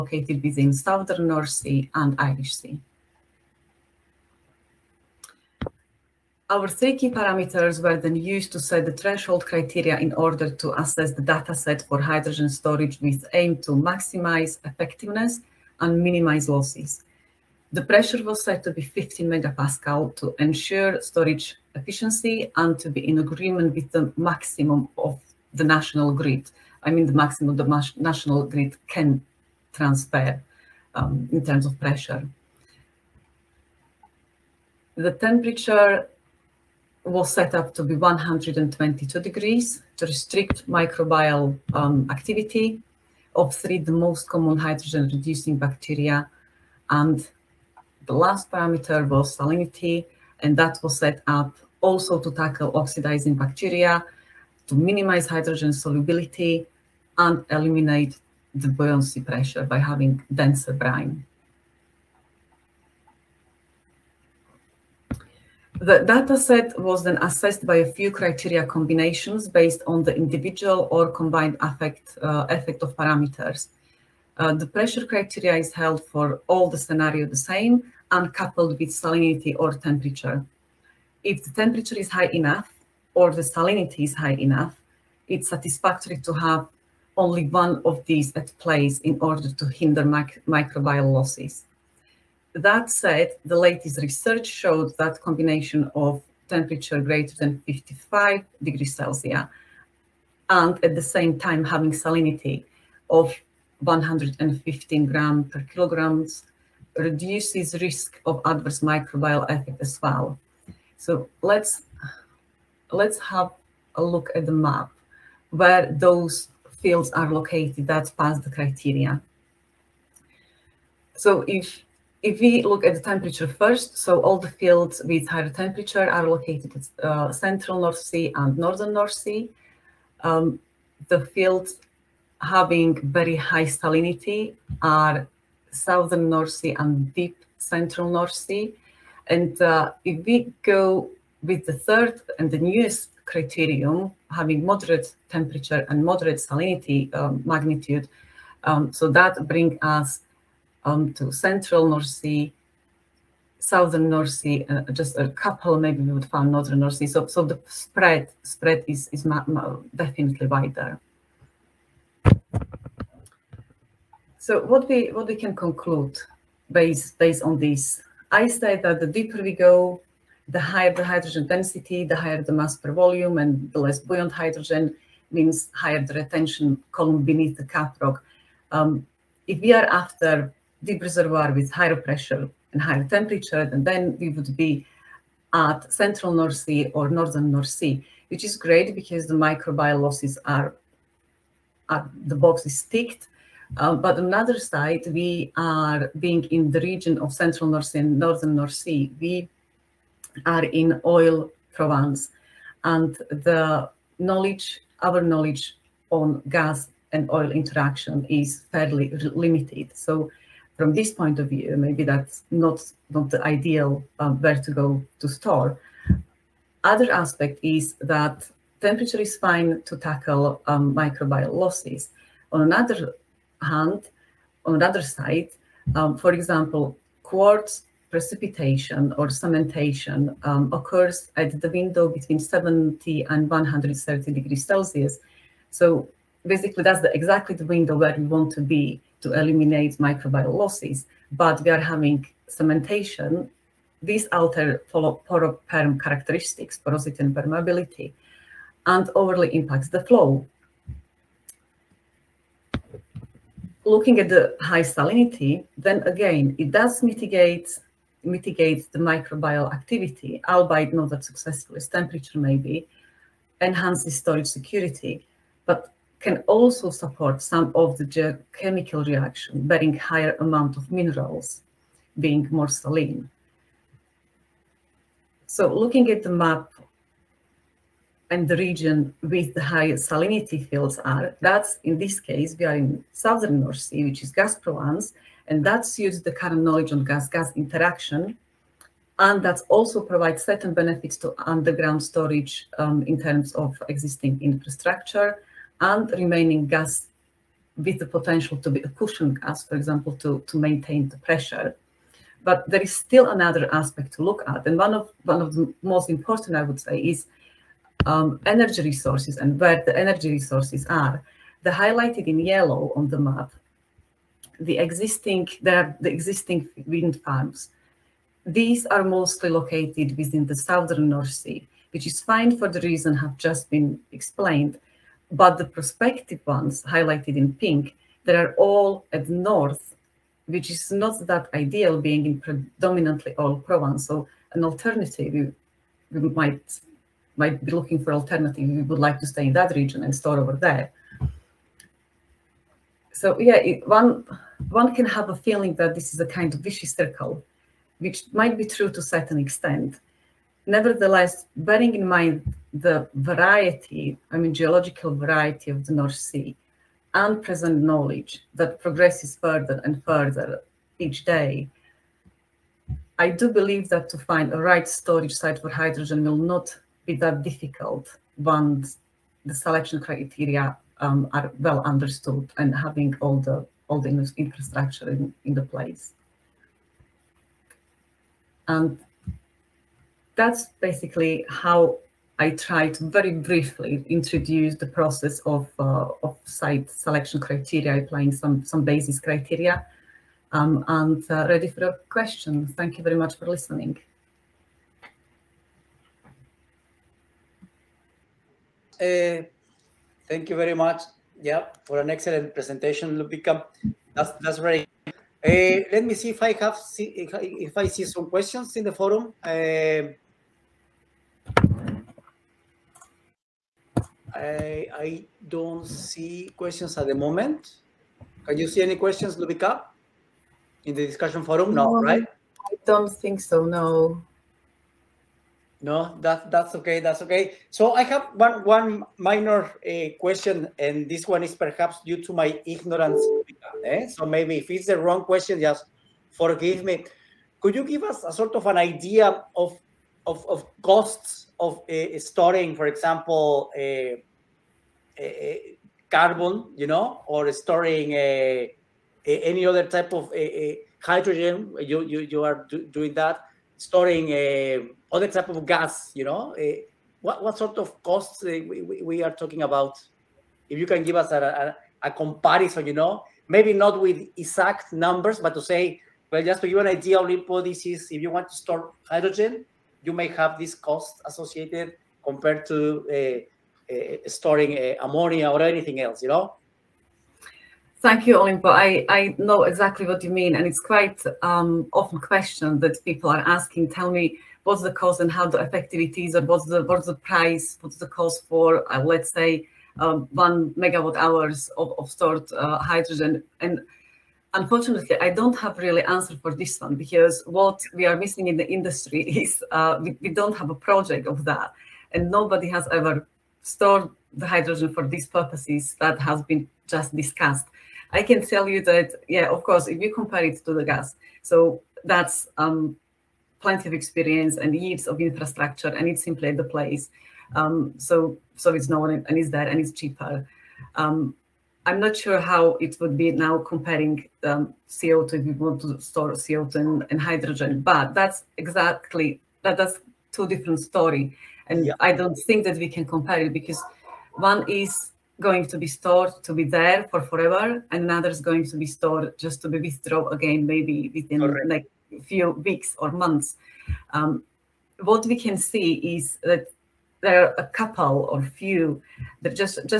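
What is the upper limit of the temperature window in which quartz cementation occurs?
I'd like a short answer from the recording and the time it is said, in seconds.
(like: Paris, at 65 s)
130 degrees Celsius, at 233 s.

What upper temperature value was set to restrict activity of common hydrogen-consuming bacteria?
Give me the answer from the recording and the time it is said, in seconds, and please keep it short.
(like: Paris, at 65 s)
122 degrees, at 37 s.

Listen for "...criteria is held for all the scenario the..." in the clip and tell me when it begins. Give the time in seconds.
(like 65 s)
75 s.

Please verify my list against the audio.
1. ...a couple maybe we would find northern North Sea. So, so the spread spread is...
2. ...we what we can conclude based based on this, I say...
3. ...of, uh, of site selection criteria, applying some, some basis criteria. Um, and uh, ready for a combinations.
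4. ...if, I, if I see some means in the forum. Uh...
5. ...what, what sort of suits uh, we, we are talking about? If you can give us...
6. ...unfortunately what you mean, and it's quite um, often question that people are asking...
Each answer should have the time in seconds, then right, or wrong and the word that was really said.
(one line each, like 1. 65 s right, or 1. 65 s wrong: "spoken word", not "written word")
1. 155 s right
2. 164 s right
3. 385 s wrong: "questions", not "combinations"
4. 407 s wrong: "questions", not "means"
5. 457 s wrong: "costs", not "suits"
6. 479 s wrong: "exactly", not "unfortunately".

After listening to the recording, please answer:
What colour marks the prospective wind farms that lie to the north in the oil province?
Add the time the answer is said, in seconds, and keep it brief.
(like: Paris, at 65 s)
pink, at 327 s.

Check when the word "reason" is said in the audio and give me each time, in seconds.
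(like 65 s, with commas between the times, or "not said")
322 s.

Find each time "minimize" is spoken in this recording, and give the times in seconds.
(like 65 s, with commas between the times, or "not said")
16 s, 54 s.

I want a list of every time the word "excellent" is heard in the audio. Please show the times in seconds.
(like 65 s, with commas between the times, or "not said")
402 s.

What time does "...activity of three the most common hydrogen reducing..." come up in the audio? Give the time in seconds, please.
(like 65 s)
42 s.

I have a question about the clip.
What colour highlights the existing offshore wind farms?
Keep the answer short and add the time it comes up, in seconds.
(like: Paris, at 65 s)
yellow, at 312 s.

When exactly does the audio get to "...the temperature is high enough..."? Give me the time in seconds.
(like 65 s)
81 s.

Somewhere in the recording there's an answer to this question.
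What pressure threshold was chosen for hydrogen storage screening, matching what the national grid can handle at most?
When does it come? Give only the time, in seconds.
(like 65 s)
18 s.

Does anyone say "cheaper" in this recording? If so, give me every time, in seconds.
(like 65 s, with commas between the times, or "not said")
519 s.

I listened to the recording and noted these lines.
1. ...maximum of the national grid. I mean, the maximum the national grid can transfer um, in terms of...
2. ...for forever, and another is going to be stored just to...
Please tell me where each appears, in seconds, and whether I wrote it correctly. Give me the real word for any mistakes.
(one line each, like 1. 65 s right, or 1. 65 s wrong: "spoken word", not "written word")
1. 24 s right
2. 537 s right.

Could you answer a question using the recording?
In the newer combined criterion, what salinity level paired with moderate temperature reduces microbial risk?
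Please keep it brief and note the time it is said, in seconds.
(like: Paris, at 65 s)
115 g/kg, at 103 s.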